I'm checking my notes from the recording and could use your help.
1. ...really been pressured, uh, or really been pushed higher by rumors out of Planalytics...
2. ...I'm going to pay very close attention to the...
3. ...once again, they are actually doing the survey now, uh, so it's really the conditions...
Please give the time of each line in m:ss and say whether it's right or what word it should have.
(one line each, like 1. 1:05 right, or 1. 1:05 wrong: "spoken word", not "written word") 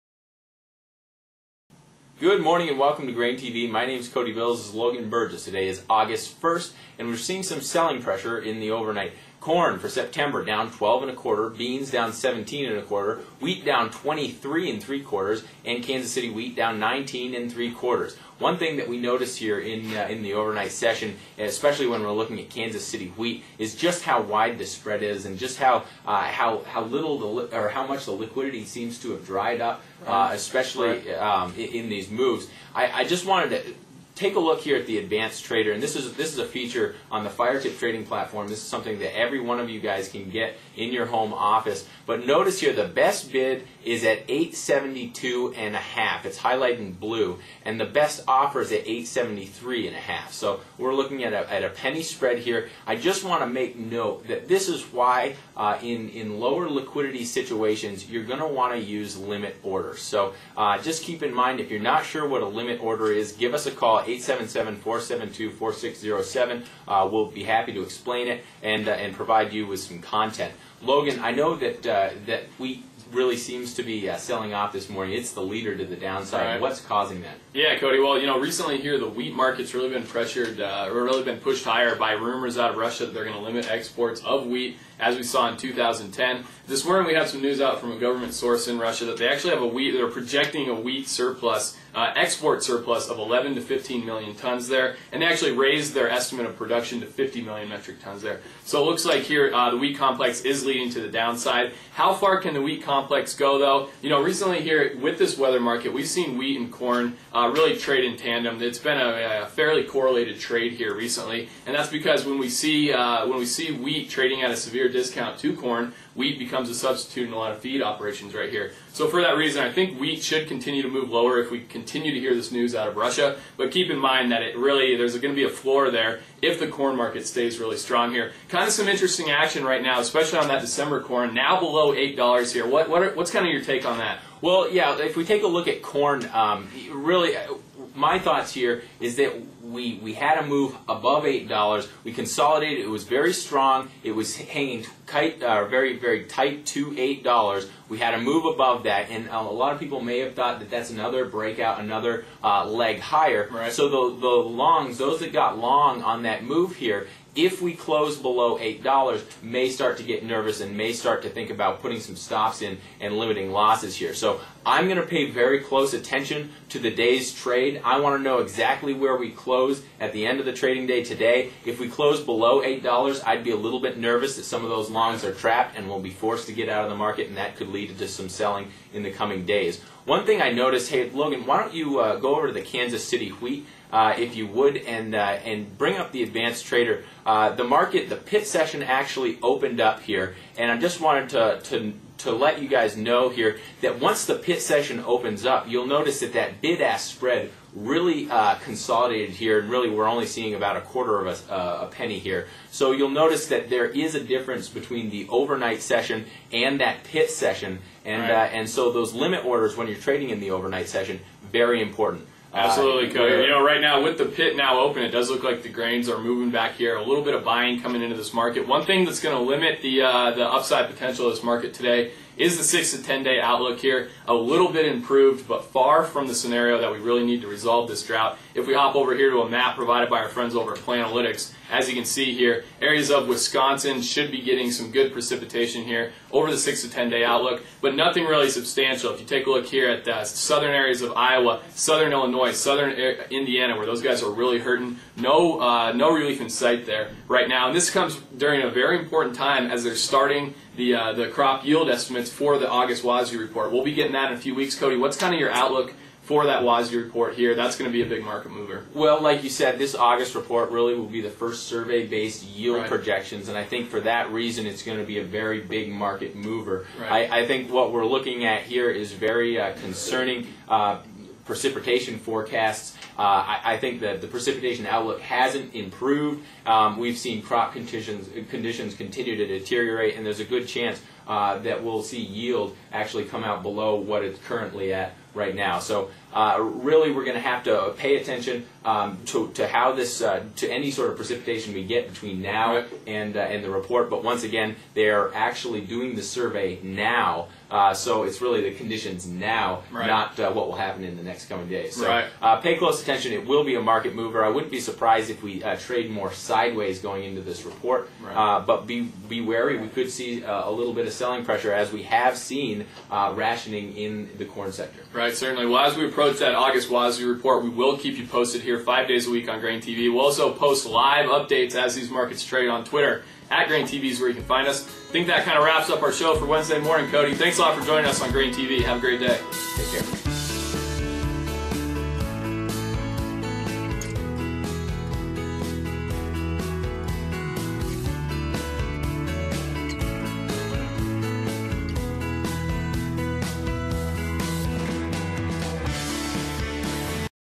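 1. 1:19 wrong: "Russia", not "Planalytics"
2. 2:44 right
3. 4:54 right.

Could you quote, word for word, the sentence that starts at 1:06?
Uh, we'll be happy to explain it and, uh, and provide you with some content.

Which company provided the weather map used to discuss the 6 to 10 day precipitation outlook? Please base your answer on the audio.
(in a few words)
Planalytics.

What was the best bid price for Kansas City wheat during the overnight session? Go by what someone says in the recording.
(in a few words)
872 and a half.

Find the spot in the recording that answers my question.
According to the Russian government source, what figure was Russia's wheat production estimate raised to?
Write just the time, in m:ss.
1:37.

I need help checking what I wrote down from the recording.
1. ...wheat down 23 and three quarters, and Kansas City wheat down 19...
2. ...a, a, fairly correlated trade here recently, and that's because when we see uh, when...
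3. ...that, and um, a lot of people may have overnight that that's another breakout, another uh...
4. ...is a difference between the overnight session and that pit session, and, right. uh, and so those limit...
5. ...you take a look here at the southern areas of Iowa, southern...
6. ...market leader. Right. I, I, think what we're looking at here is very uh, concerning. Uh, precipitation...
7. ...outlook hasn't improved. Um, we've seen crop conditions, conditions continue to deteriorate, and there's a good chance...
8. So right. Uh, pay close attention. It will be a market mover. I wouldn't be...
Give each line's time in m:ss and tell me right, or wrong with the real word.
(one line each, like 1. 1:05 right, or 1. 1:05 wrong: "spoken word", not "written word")
1. 0:13 right
2. 1:48 right
3. 2:28 wrong: "thought", not "overnight"
4. 3:23 right
5. 3:59 right
6. 4:25 wrong: "mover", not "leader"
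7. 4:34 right
8. 5:01 right.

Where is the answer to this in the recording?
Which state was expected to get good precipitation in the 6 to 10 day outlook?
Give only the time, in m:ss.
3:53.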